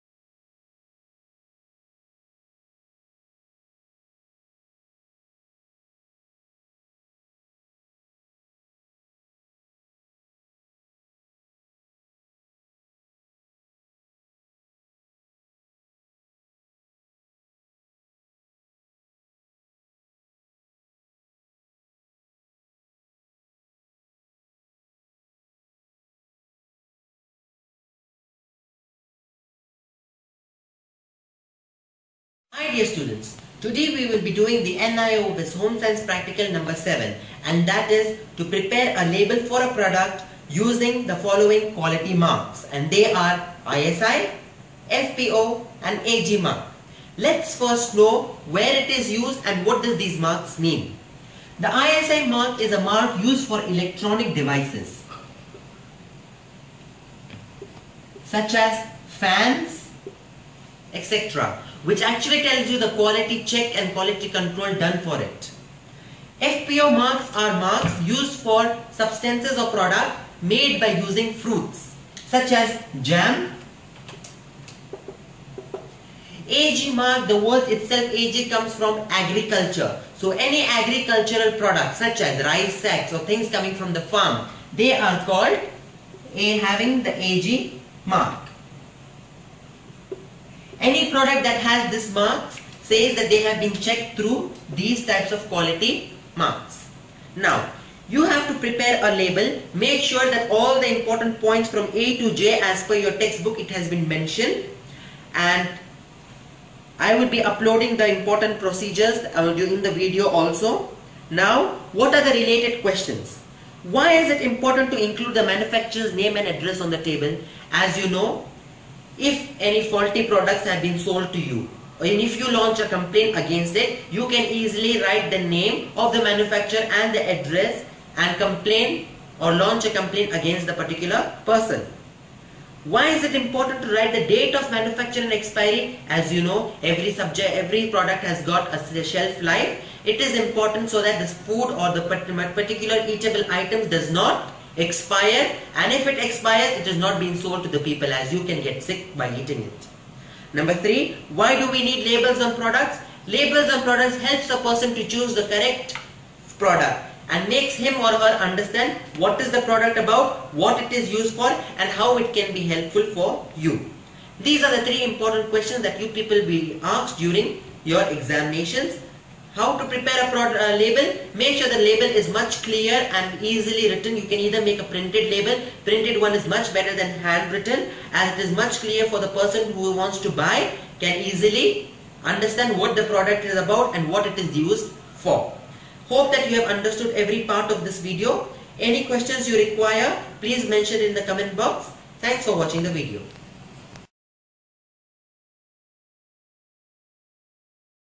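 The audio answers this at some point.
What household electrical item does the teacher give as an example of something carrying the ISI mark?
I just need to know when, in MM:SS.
00:59.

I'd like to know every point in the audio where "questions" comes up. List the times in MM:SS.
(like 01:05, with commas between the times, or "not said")
01:52, 02:45, 03:09.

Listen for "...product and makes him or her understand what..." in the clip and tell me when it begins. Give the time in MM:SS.
02:36.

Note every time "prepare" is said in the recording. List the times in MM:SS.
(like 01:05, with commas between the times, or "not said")
00:38, 01:38, 02:49.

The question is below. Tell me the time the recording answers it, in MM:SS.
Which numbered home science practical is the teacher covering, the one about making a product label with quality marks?
00:36.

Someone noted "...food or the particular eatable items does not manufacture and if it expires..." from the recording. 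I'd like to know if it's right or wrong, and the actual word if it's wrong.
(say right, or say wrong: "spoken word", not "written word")
wrong: "expire", not "manufacture".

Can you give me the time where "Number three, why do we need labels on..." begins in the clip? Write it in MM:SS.
02:30.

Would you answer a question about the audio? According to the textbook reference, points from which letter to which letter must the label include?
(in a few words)
A to J.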